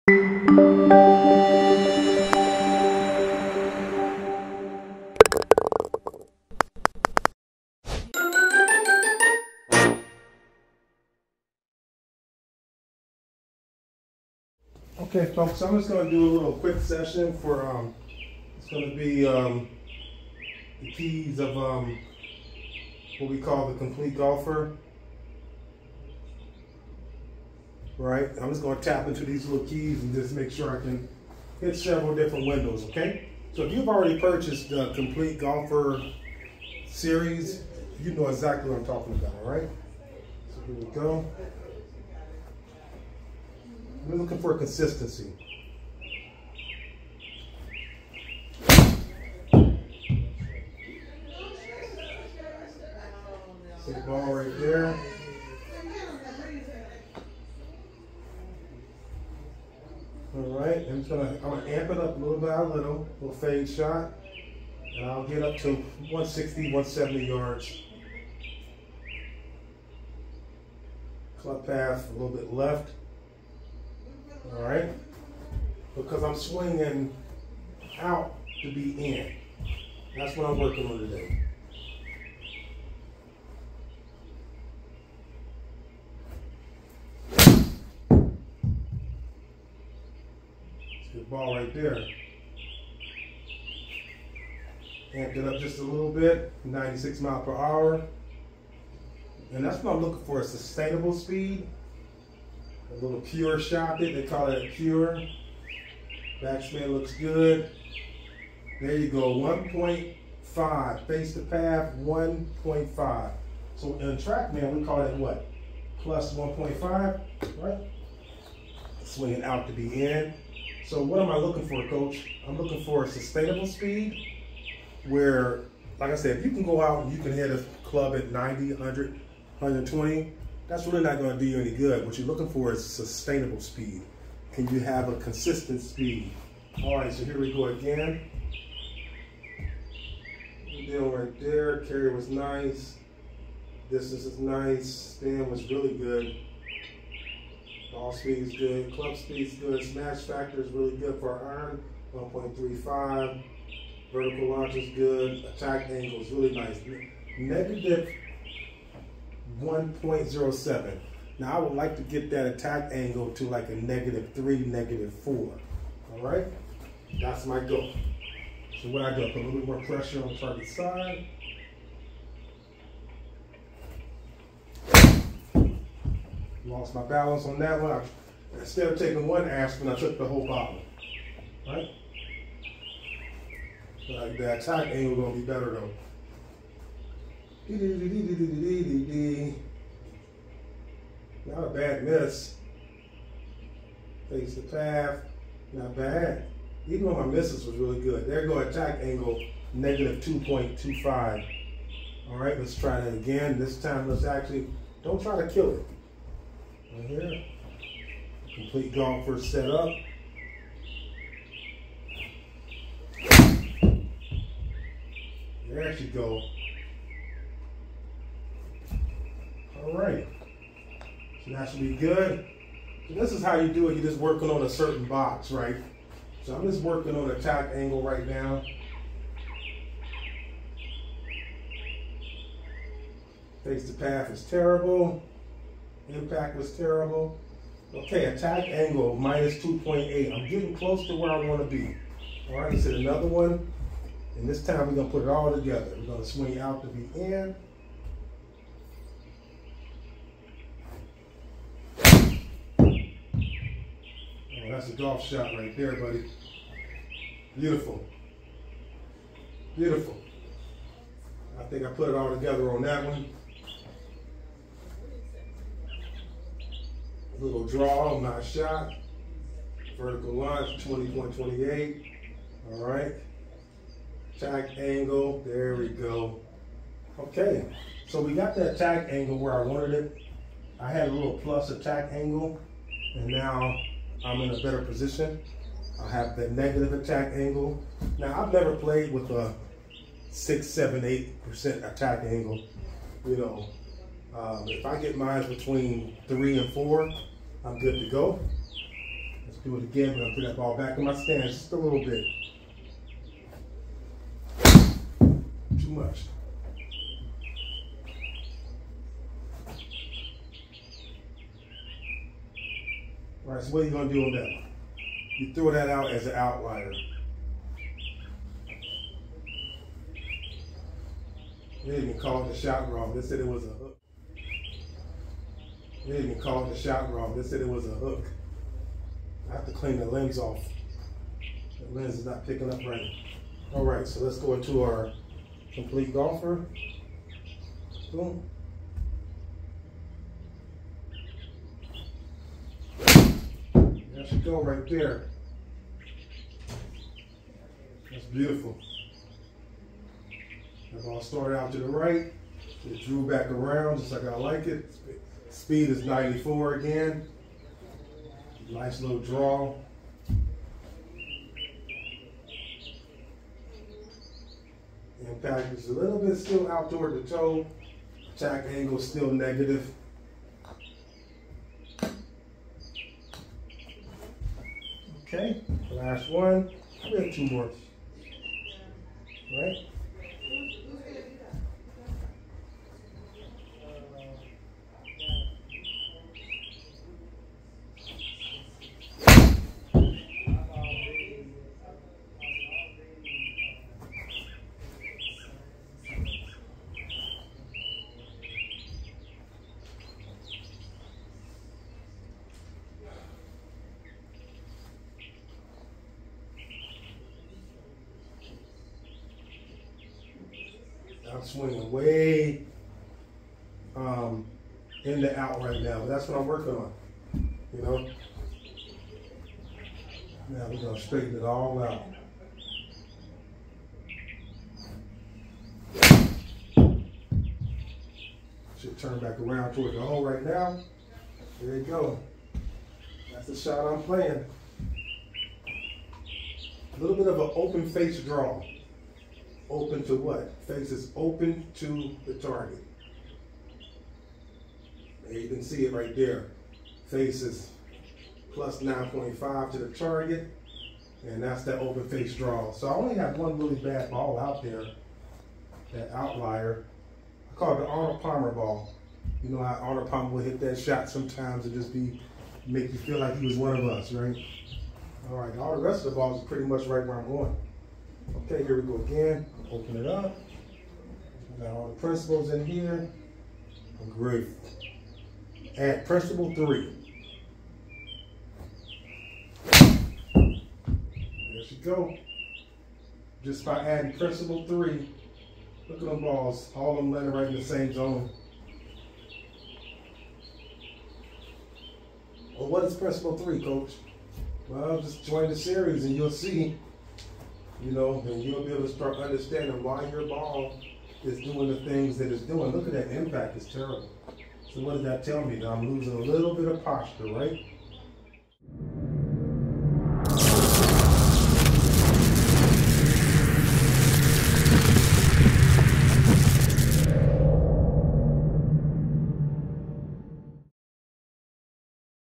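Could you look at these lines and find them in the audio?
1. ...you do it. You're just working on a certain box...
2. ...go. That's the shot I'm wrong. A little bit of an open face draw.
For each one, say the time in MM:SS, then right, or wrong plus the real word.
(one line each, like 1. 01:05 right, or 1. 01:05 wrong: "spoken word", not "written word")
1. 03:43 right
2. 07:11 wrong: "playing", not "wrong".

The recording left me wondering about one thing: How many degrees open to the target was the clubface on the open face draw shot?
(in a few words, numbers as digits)
9.5.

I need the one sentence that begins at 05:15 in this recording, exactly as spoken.
You throw that out as an outlier.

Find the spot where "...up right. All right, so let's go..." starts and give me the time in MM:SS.
05:32.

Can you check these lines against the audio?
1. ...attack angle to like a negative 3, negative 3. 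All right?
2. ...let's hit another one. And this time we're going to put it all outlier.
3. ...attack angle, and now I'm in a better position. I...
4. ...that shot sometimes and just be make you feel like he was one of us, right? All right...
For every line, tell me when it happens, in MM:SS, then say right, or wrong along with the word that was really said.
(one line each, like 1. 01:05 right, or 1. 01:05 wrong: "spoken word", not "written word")
1. 02:42 wrong: "4", not "3"
2. 04:02 wrong: "together", not "outlier"
3. 04:41 right
4. 07:40 right.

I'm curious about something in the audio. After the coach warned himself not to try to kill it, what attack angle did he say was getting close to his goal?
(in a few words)
-2.8.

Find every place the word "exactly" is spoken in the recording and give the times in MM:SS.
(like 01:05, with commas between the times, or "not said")
00:38.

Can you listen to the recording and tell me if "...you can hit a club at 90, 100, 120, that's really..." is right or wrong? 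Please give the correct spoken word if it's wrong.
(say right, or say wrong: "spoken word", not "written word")
right.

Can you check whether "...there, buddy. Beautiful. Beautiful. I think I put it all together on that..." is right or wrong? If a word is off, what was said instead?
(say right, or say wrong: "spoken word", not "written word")
right.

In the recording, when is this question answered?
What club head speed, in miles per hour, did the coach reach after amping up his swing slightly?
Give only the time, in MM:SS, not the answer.
01:36.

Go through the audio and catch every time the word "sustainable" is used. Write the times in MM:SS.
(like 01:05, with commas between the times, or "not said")
01:40, 02:03, 02:12.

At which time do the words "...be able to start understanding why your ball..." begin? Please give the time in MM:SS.
08:18.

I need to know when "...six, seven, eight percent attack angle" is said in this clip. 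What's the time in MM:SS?
04:50.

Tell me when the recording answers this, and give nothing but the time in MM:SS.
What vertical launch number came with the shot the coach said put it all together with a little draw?
04:30.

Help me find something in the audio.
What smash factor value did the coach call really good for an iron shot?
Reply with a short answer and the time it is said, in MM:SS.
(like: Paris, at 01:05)
1.35, at 02:32.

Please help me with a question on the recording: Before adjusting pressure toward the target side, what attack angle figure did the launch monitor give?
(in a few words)
-1.07.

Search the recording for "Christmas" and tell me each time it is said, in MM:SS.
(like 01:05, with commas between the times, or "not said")
not said.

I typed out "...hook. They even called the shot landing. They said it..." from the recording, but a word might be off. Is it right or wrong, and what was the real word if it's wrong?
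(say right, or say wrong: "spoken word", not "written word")
wrong: "wrong", not "landing".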